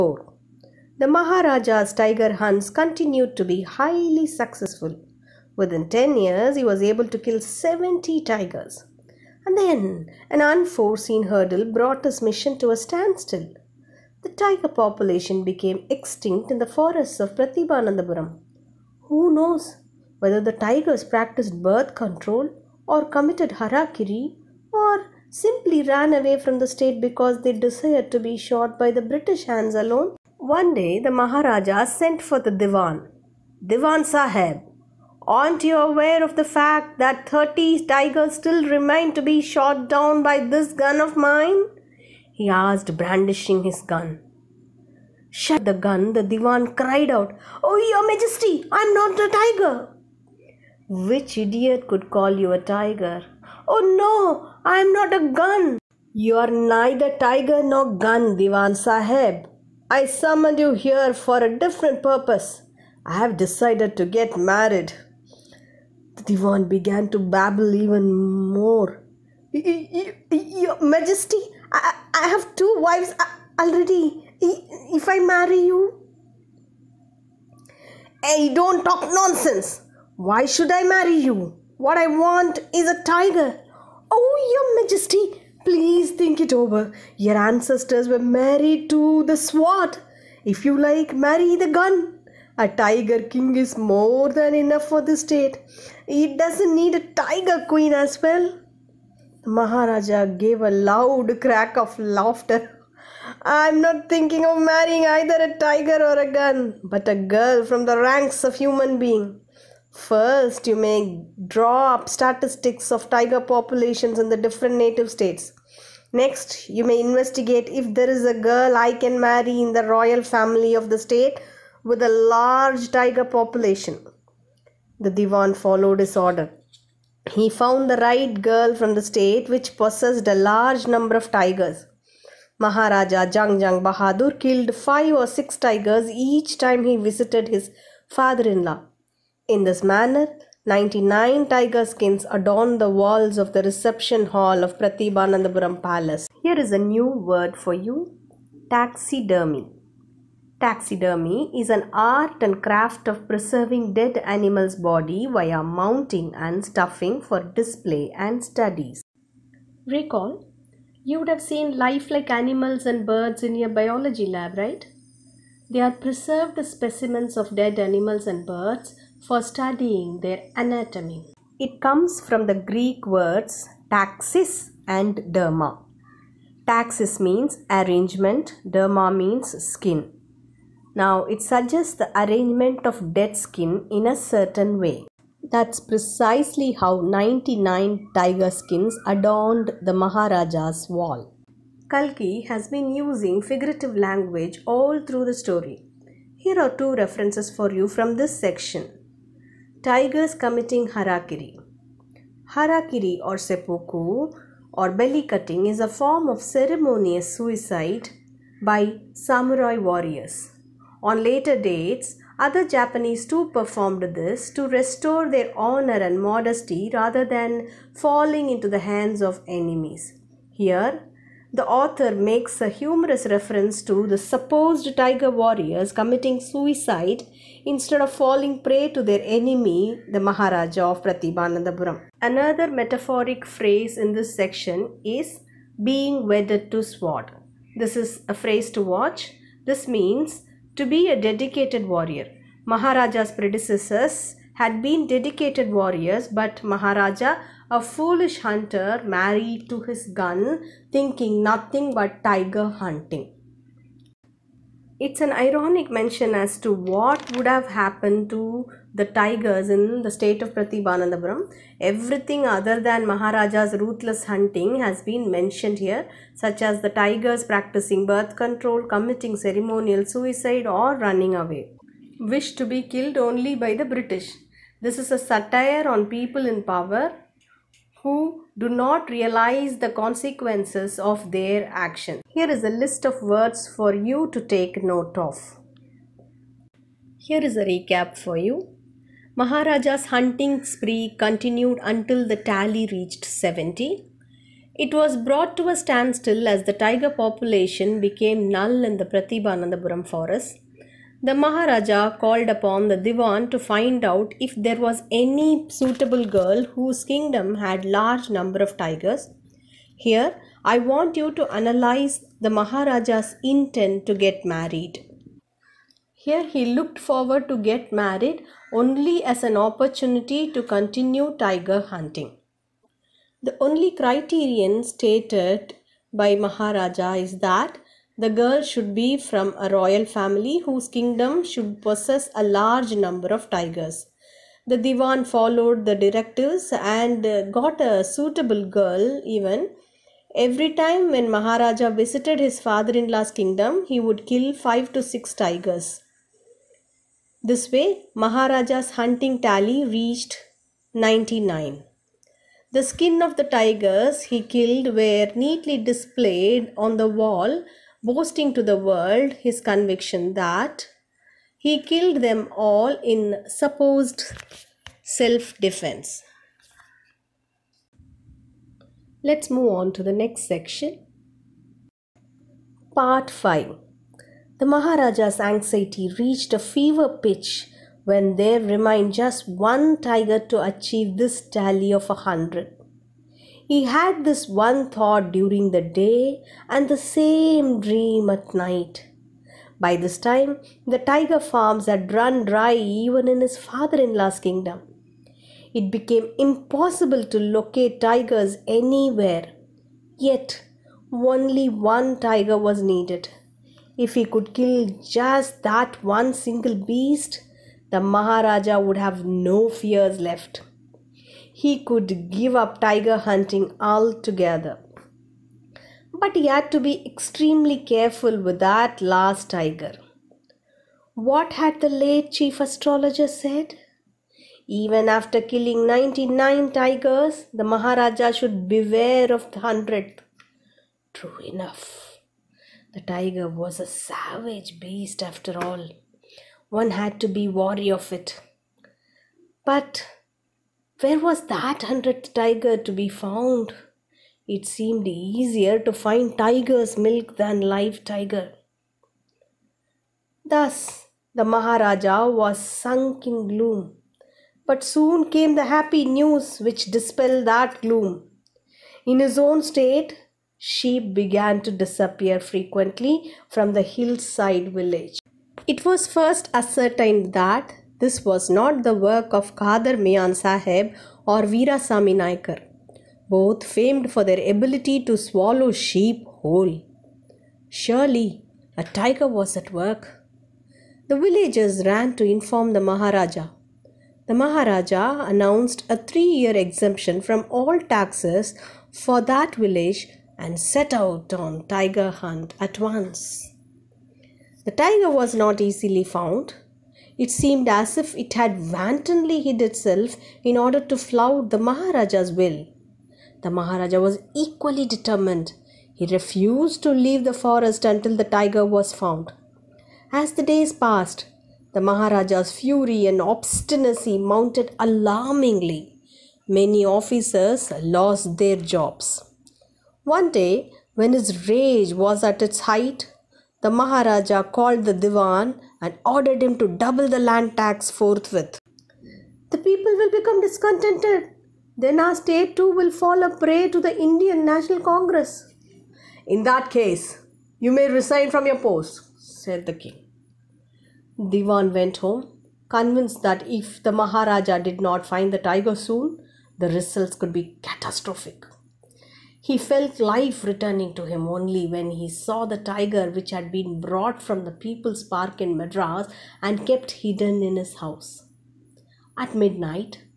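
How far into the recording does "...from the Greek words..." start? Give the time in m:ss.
2:52.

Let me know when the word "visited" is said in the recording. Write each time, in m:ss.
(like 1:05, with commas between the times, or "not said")
2:16, 5:41.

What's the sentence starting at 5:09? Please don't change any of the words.
Here, I want you to analyze the Maharaja's intent to get married.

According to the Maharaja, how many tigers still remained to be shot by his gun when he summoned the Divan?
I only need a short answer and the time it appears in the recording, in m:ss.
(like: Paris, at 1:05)
30, at 0:37.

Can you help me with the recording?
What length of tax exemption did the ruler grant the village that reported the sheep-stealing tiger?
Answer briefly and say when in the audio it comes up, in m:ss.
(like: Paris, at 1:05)
3 years, at 8:05.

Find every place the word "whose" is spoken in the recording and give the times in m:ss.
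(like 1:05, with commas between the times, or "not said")
5:06, 5:30.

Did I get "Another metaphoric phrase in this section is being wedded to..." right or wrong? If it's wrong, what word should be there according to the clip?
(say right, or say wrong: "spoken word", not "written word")
right.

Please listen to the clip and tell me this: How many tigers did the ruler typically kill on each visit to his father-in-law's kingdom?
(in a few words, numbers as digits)
5 or 6.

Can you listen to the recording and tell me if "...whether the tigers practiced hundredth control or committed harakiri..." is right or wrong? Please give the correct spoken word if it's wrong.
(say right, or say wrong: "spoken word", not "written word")
wrong: "birth", not "hundredth".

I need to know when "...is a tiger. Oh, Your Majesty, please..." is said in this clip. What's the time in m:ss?
1:22.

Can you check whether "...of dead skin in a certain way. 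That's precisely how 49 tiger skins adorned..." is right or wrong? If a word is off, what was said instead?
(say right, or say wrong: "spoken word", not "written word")
wrong: "99", not "49".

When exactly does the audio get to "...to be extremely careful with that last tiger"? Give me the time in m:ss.
6:56.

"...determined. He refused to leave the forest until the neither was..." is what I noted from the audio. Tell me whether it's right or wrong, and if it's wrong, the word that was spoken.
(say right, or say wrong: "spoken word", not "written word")
wrong: "tiger", not "neither".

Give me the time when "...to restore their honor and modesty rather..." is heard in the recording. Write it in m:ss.
3:34.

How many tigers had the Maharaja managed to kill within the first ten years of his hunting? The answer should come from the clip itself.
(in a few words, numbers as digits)
70.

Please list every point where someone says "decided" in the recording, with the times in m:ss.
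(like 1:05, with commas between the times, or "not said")
1:03.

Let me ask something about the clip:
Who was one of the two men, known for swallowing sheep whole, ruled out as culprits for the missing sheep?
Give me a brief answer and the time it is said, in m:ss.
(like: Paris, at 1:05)
Kadar Mian Sahib, at 7:49.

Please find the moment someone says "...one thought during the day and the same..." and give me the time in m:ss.
6:24.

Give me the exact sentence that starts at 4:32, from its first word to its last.
Wish to be killed only by the British.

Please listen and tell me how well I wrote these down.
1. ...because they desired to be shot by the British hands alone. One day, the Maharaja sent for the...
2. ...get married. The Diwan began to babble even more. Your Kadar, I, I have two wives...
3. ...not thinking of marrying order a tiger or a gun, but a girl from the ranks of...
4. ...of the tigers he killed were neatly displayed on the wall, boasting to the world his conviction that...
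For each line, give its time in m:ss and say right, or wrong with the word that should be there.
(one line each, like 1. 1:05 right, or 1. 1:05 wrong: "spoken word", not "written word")
1. 0:27 right
2. 1:04 wrong: "Majesty", not "Kadar"
3. 1:43 wrong: "either", not "order"
4. 5:53 right.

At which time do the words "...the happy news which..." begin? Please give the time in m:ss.
7:35.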